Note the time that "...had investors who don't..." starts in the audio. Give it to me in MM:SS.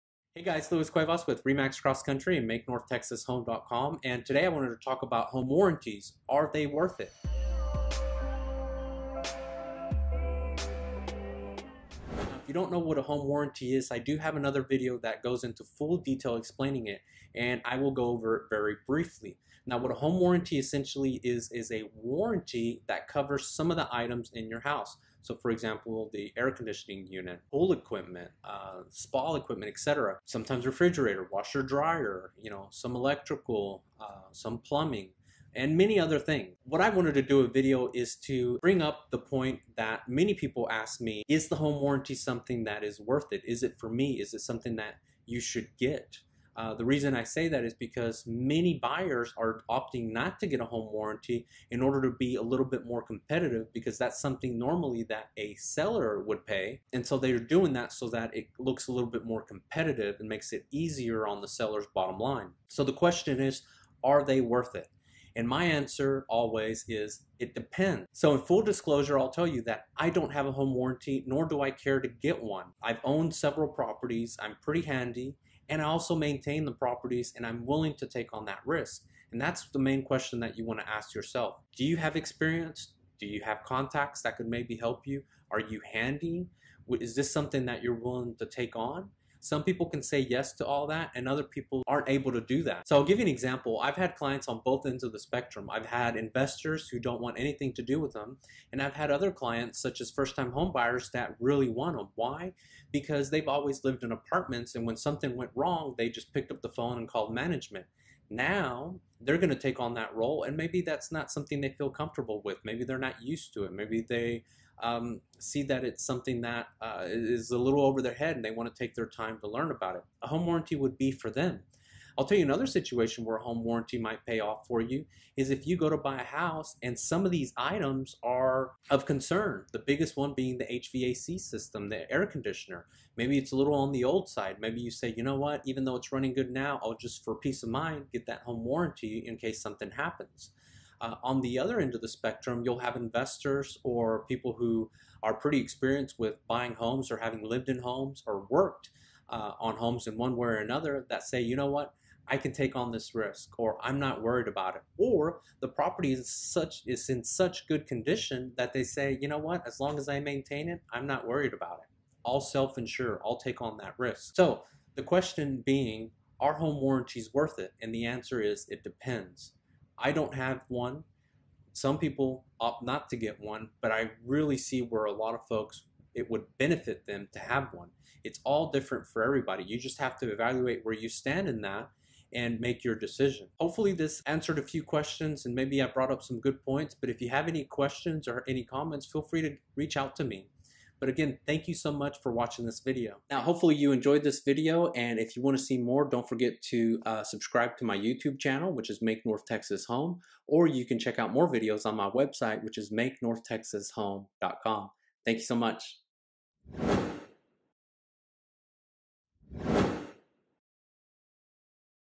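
01:35.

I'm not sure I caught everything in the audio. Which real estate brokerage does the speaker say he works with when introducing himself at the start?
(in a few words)
Remax Cross Country.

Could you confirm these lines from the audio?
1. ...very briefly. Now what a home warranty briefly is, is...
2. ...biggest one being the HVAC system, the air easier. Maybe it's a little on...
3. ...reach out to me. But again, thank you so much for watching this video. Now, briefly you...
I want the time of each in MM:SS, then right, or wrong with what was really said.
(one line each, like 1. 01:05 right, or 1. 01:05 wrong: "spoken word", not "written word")
1. 00:18 wrong: "essentially", not "briefly"
2. 02:09 wrong: "conditioner", not "easier"
3. 03:09 wrong: "hopefully", not "briefly".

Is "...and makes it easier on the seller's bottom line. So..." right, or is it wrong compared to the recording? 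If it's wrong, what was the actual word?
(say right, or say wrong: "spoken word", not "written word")
right.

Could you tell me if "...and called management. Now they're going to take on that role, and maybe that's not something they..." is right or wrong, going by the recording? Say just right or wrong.
right.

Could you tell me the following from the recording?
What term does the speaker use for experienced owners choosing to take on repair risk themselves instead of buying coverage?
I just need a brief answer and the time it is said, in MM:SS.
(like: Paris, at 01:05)
Self-insure, at 02:42.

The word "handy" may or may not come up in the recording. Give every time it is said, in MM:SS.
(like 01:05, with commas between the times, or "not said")
01:14, 01:25.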